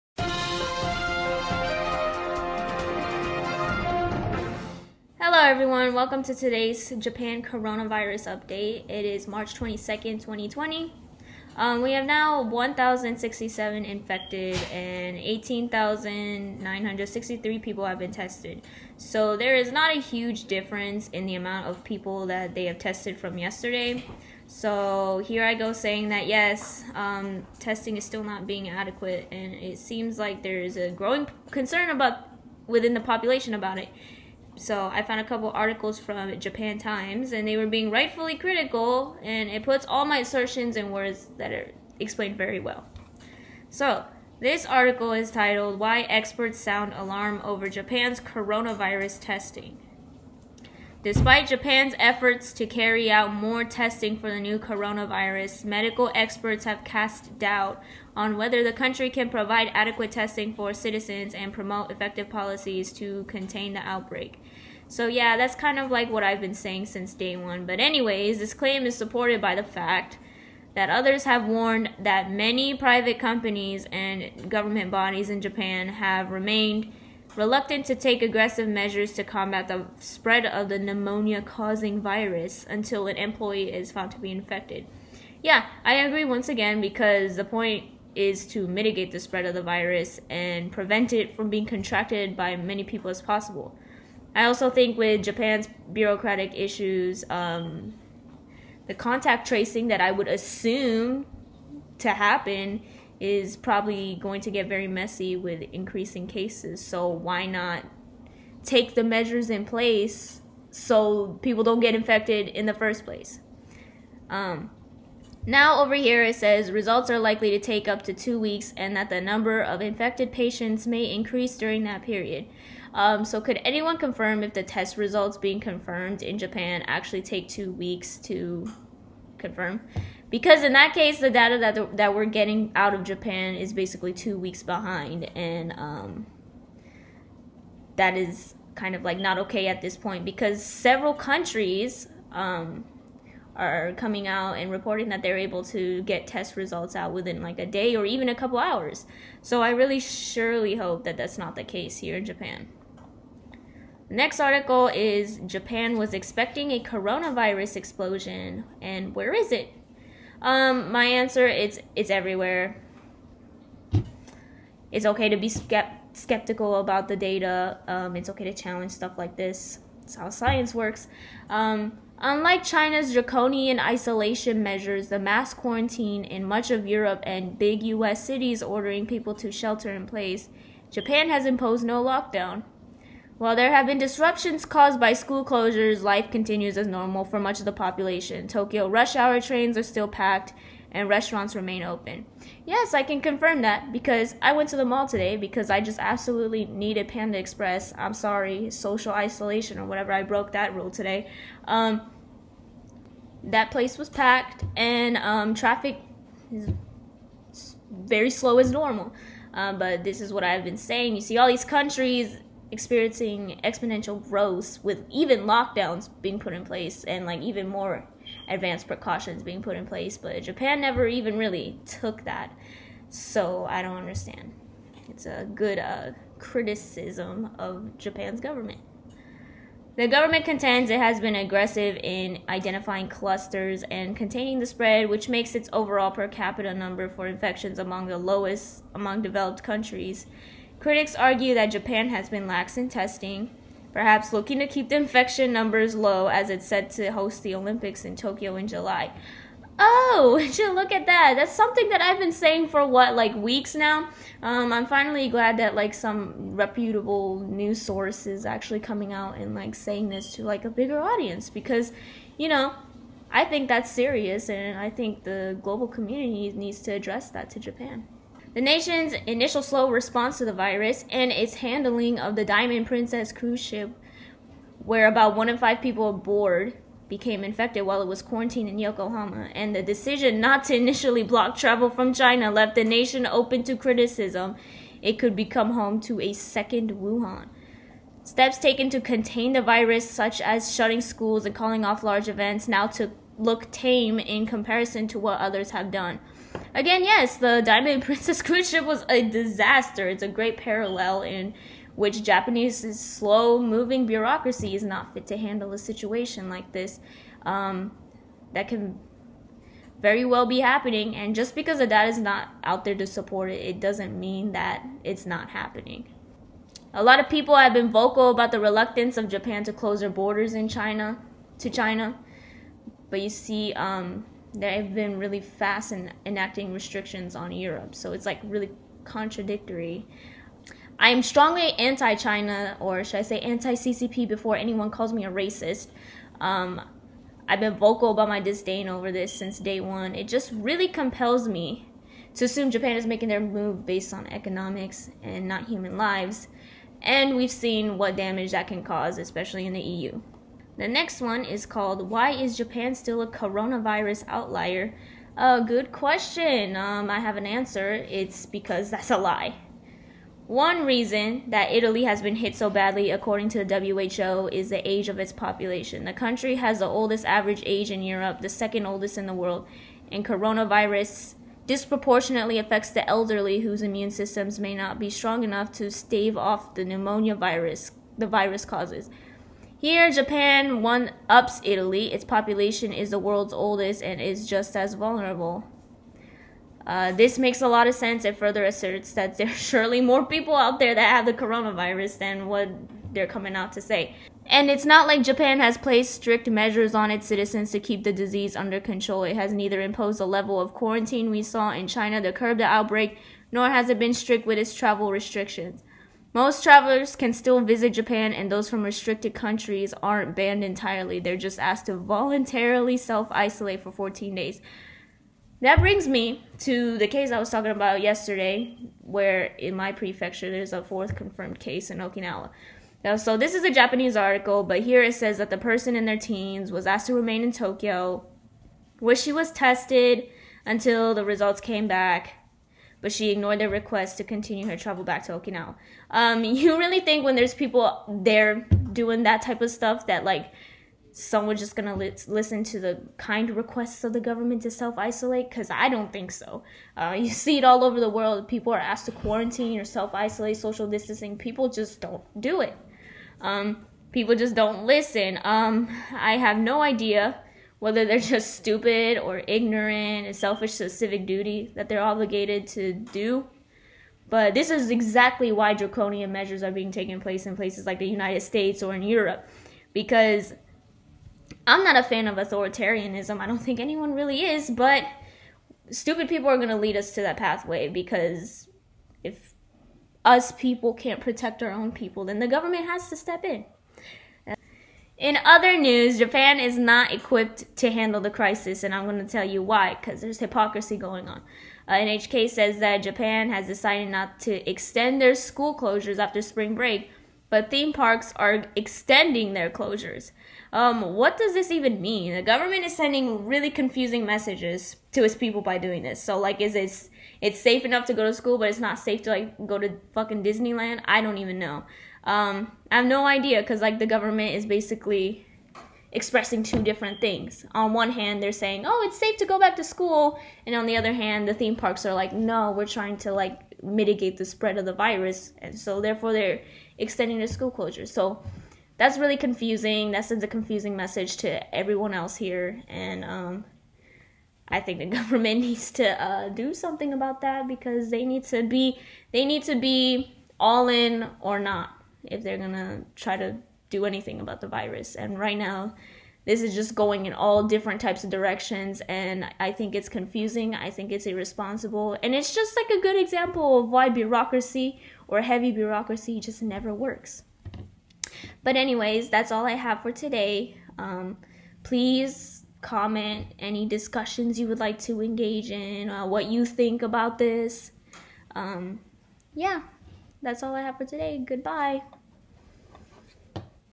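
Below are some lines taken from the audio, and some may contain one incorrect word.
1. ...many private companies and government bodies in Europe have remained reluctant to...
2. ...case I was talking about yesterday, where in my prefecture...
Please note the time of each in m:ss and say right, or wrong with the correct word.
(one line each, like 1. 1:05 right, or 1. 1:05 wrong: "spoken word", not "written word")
1. 1:12 wrong: "Japan", not "Europe"
2. 6:57 right.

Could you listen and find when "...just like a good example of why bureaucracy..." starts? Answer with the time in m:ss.
9:12.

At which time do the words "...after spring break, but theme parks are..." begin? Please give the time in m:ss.
8:16.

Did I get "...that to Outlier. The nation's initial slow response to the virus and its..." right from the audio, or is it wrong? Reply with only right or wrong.
wrong.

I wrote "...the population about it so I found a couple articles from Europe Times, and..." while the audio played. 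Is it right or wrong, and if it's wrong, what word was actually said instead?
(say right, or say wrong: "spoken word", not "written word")
wrong: "Japan", not "Europe".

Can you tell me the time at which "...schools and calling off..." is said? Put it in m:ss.
4:50.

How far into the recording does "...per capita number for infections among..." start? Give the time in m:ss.
3:56.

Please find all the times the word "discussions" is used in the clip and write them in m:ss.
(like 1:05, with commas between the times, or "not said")
9:23.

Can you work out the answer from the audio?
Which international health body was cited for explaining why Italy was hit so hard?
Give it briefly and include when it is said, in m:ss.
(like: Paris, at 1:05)
WHO, at 6:03.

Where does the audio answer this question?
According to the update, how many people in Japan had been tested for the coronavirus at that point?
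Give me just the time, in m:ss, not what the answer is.
0:15.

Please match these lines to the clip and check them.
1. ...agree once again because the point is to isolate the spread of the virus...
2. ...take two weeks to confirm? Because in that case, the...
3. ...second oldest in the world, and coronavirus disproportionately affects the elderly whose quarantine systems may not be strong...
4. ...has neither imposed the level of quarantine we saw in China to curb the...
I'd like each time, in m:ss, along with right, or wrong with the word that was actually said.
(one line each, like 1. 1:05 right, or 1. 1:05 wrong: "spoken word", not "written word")
1. 1:25 wrong: "mitigate", not "isolate"
2. 2:07 right
3. 6:08 wrong: "immune", not "quarantine"
4. 6:39 right.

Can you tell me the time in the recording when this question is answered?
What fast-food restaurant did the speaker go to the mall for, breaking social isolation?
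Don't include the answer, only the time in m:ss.
3:17.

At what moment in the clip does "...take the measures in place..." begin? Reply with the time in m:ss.
1:48.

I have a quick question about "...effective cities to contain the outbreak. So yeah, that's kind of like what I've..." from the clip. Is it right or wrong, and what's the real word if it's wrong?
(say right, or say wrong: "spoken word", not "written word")
wrong: "policies", not "cities".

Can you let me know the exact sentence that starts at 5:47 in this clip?
And we've seen what damage that can cause, especially in the EU.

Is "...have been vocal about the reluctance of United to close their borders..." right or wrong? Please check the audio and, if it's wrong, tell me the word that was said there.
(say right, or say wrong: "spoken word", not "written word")
wrong: "Japan", not "United".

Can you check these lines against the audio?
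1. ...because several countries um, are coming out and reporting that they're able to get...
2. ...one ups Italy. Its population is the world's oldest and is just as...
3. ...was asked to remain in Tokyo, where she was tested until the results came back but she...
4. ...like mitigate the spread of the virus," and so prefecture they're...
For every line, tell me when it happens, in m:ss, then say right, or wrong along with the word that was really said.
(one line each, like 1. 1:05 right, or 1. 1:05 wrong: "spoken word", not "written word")
1. 2:20 right
2. 6:20 right
3. 7:06 right
4. 8:43 wrong: "therefore", not "prefecture".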